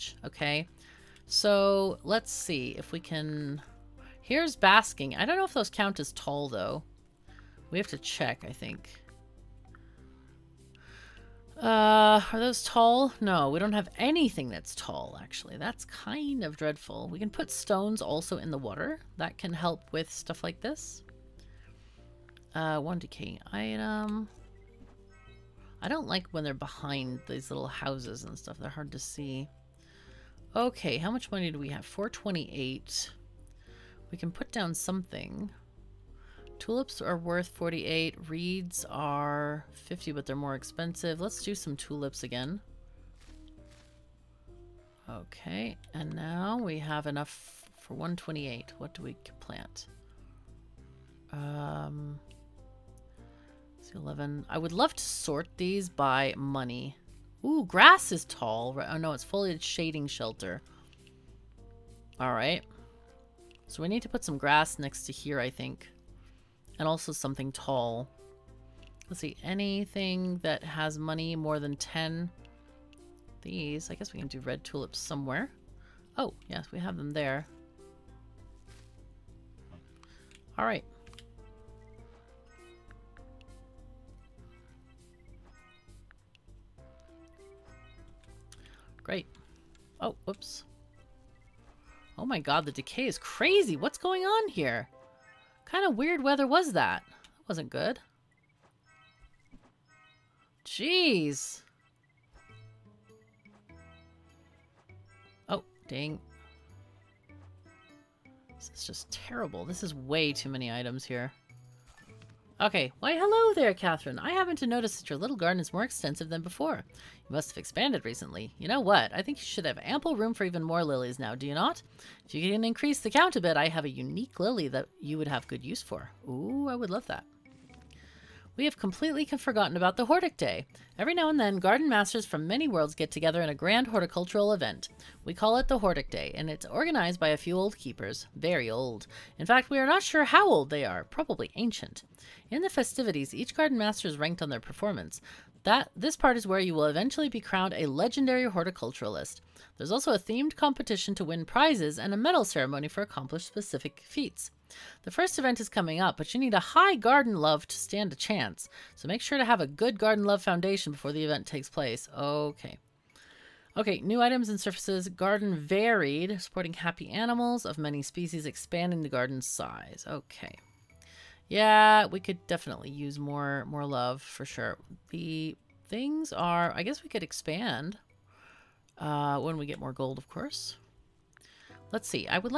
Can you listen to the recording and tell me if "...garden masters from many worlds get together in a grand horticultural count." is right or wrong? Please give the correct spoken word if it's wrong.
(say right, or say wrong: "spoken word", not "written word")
wrong: "event", not "count".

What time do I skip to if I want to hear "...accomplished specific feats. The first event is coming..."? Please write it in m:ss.
2:33.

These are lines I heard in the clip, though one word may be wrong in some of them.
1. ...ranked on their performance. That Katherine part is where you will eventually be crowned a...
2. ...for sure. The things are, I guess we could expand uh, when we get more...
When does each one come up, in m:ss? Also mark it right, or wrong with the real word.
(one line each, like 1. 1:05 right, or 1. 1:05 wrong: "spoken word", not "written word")
1. 2:24 wrong: "This", not "Katherine"
2. 2:54 right.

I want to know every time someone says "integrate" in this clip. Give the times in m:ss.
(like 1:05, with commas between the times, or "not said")
not said.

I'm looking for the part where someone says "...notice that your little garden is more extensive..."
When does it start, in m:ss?
1:54.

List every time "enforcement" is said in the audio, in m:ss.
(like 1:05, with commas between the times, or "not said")
not said.